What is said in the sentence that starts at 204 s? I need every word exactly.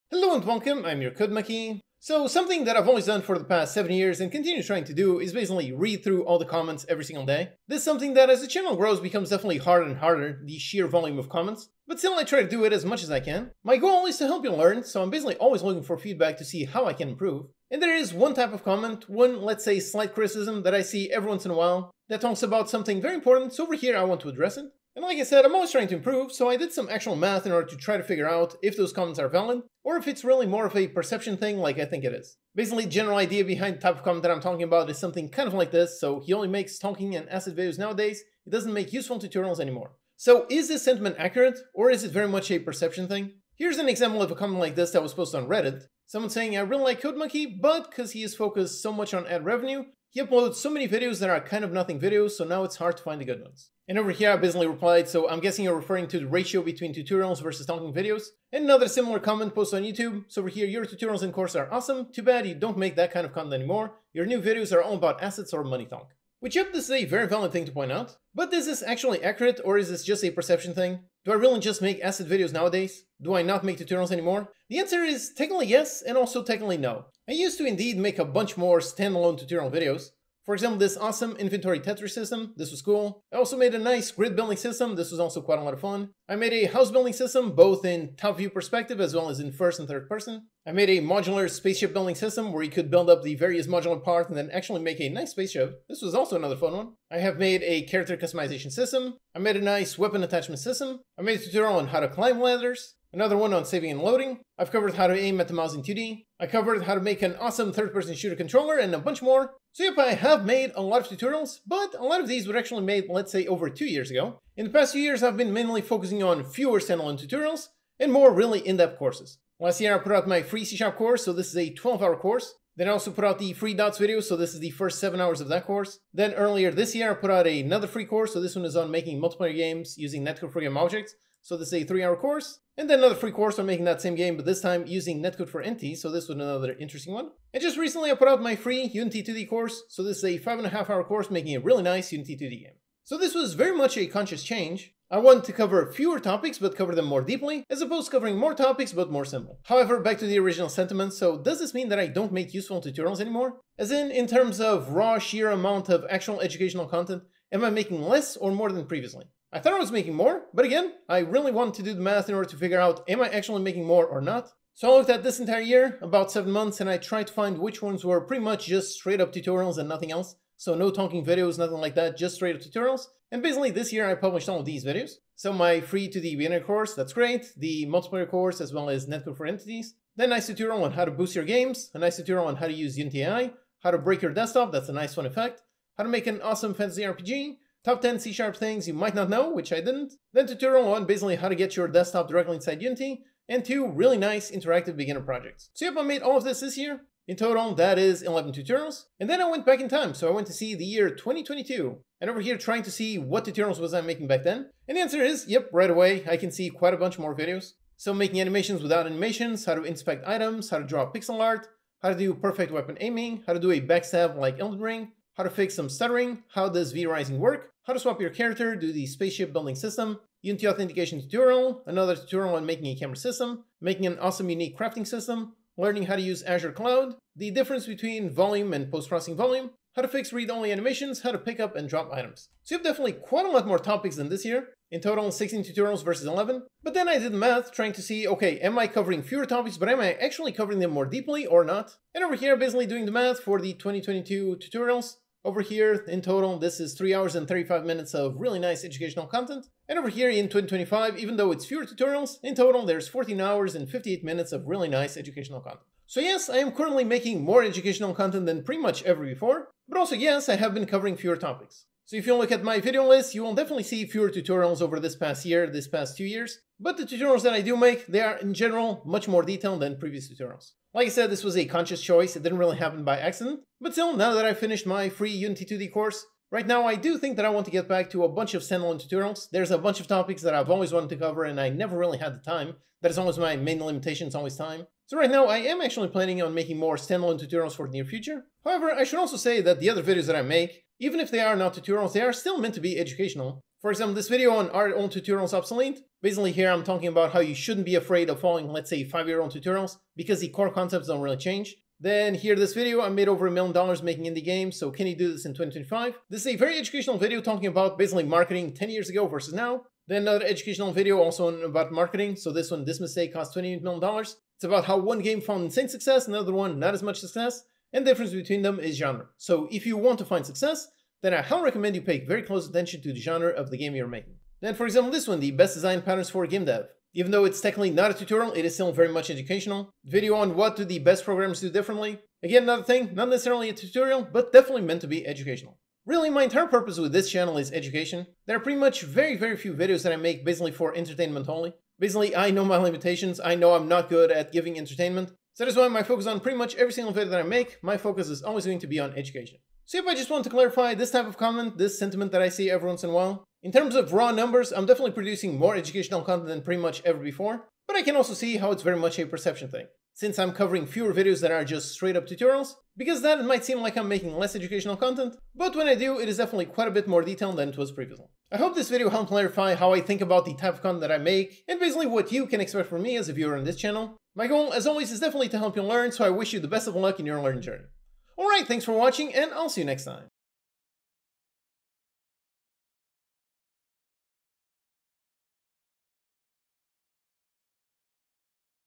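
And the answer is, yep, right away, I can see quite a bunch more videos.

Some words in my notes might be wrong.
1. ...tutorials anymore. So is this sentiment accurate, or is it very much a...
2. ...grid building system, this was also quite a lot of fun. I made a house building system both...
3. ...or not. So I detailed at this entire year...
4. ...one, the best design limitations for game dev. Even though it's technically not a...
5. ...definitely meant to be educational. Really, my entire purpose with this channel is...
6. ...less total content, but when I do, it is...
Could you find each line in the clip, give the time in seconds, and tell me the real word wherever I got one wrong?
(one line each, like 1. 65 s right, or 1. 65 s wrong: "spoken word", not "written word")
1. 39 s right
2. 84 s right
3. 164 s wrong: "looked", not "detailed"
4. 325 s wrong: "patterns", not "limitations"
5. 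334 s right
6. 364 s wrong: "educational", not "total".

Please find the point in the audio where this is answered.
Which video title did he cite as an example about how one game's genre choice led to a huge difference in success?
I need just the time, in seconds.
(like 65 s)
312 s.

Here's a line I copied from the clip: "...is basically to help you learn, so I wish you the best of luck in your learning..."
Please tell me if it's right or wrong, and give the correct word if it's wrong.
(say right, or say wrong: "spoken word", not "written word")
wrong: "definitely", not "basically".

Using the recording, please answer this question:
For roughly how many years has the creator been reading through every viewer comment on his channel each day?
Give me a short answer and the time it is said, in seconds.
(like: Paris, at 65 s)
7 years, at 3 s.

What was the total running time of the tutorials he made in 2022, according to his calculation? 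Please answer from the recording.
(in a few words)
3 hours and 35 minutes.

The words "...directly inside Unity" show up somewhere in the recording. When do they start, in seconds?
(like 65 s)
192 s.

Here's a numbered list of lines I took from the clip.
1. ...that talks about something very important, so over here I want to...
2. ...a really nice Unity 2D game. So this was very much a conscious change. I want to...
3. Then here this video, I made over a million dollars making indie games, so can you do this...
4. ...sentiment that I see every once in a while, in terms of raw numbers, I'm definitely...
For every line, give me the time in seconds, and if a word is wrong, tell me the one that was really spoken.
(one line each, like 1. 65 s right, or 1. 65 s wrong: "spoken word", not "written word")
1. 22 s right
2. 141 s right
3. 301 s right
4. 351 s right.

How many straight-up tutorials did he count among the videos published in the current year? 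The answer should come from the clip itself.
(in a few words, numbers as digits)
11.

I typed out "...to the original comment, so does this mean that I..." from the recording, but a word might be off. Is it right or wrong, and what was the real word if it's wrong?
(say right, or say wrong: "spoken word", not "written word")
wrong: "sentiment", not "comment".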